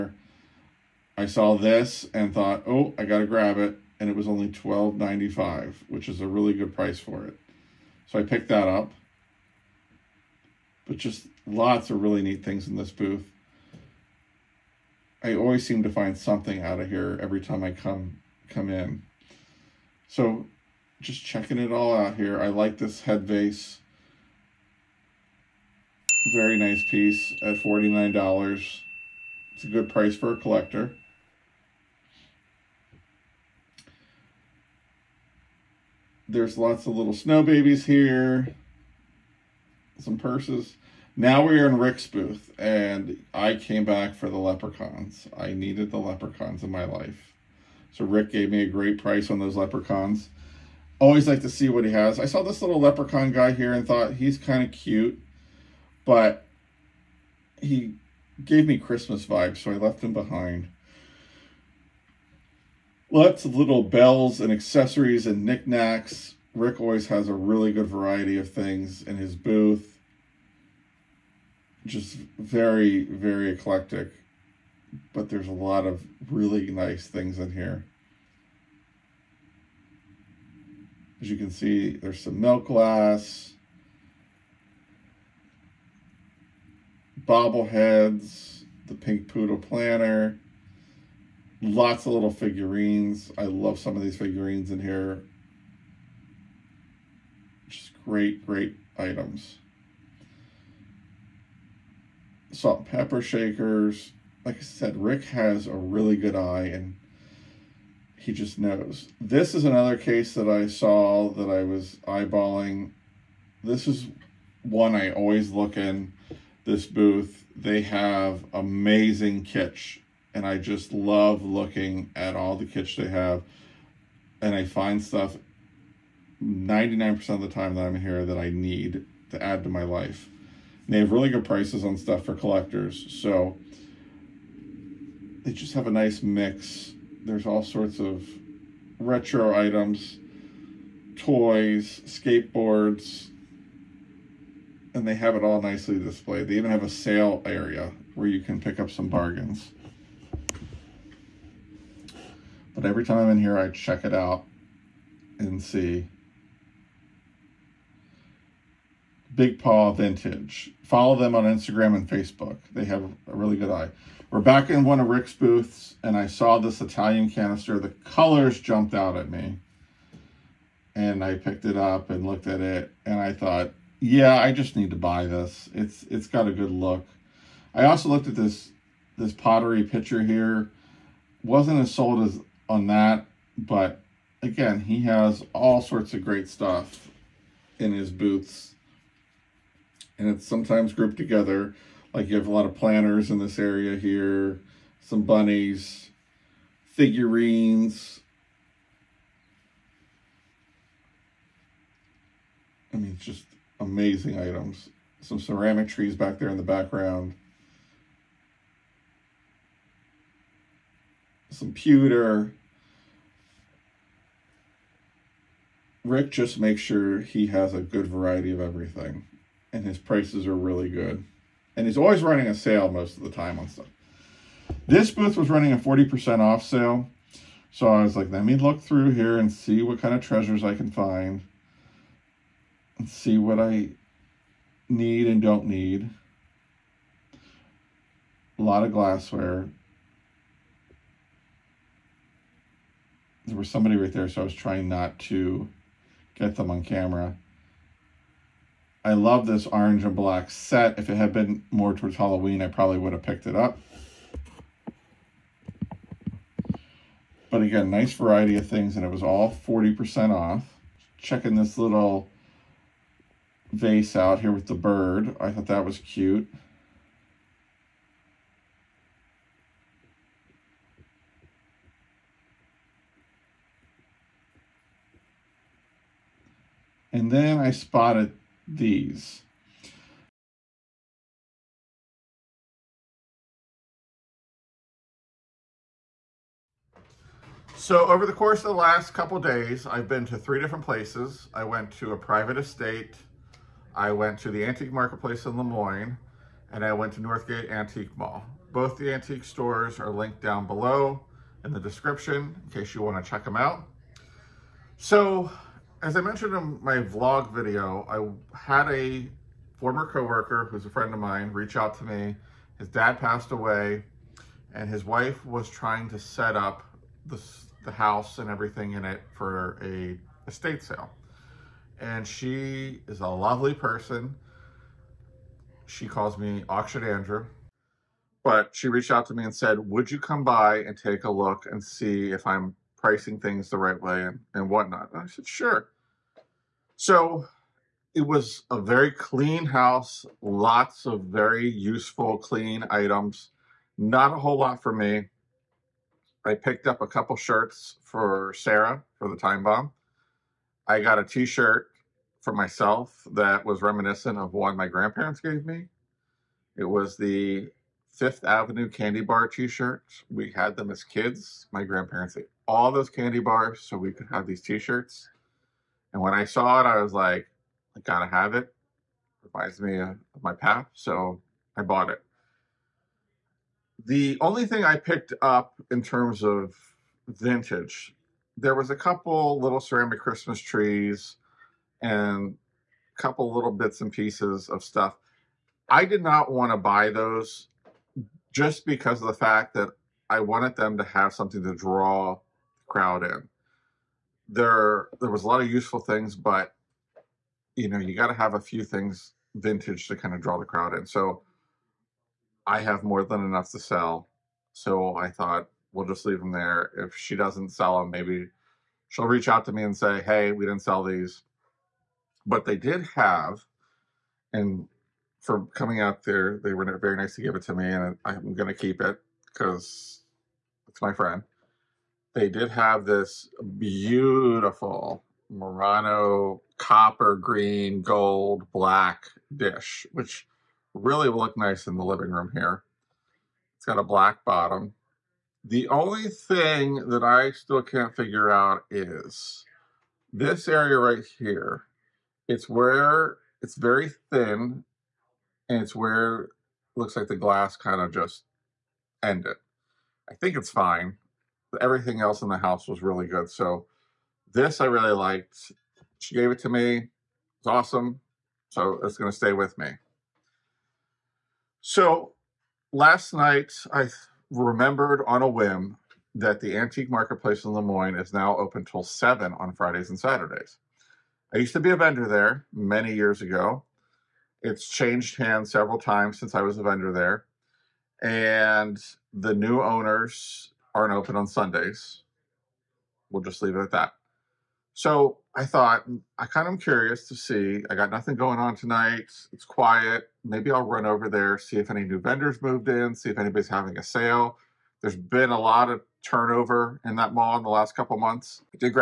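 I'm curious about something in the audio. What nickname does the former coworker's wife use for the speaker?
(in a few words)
Auction Andrew.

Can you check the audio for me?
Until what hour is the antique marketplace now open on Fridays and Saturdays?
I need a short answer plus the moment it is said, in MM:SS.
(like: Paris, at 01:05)
7, at 07:49.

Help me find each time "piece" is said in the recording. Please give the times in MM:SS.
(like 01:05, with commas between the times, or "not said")
00:26, 06:24.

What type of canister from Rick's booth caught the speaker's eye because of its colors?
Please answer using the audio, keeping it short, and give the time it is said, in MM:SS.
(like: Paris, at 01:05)
Italian, at 02:46.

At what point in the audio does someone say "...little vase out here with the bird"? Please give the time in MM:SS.
04:21.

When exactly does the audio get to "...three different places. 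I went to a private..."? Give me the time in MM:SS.
04:50.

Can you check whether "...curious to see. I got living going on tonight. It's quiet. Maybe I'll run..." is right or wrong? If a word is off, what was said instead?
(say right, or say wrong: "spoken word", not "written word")
wrong: "nothing", not "living".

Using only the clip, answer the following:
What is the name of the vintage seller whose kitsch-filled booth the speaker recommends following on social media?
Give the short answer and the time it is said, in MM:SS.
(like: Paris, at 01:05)
Big Paw Vintage, at 02:39.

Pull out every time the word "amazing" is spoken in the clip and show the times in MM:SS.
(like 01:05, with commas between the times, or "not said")
01:58, 03:23.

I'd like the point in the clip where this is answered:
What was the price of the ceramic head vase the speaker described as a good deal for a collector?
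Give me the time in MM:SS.
00:27.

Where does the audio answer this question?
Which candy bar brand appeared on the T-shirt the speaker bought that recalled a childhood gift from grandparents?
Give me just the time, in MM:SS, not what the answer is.
05:58.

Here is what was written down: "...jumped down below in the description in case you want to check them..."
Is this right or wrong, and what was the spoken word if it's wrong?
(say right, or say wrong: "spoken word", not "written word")
wrong: "linked", not "jumped".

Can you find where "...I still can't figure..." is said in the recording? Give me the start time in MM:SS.
07:17.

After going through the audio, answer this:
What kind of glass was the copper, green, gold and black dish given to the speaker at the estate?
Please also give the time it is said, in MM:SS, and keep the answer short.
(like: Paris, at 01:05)
Murano, at 07:05.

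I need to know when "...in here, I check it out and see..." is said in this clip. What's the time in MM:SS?
02:33.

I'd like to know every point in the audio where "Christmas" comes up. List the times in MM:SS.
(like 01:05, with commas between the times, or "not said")
00:58, 06:20.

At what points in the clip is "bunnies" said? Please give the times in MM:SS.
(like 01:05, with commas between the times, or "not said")
03:15.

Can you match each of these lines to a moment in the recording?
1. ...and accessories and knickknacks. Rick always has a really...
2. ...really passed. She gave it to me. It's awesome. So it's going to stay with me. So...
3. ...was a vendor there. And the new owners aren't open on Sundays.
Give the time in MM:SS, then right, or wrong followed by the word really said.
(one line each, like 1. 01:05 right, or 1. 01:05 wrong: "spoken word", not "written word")
1. 01:04 right
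2. 07:34 wrong: "liked", not "passed"
3. 07:56 right.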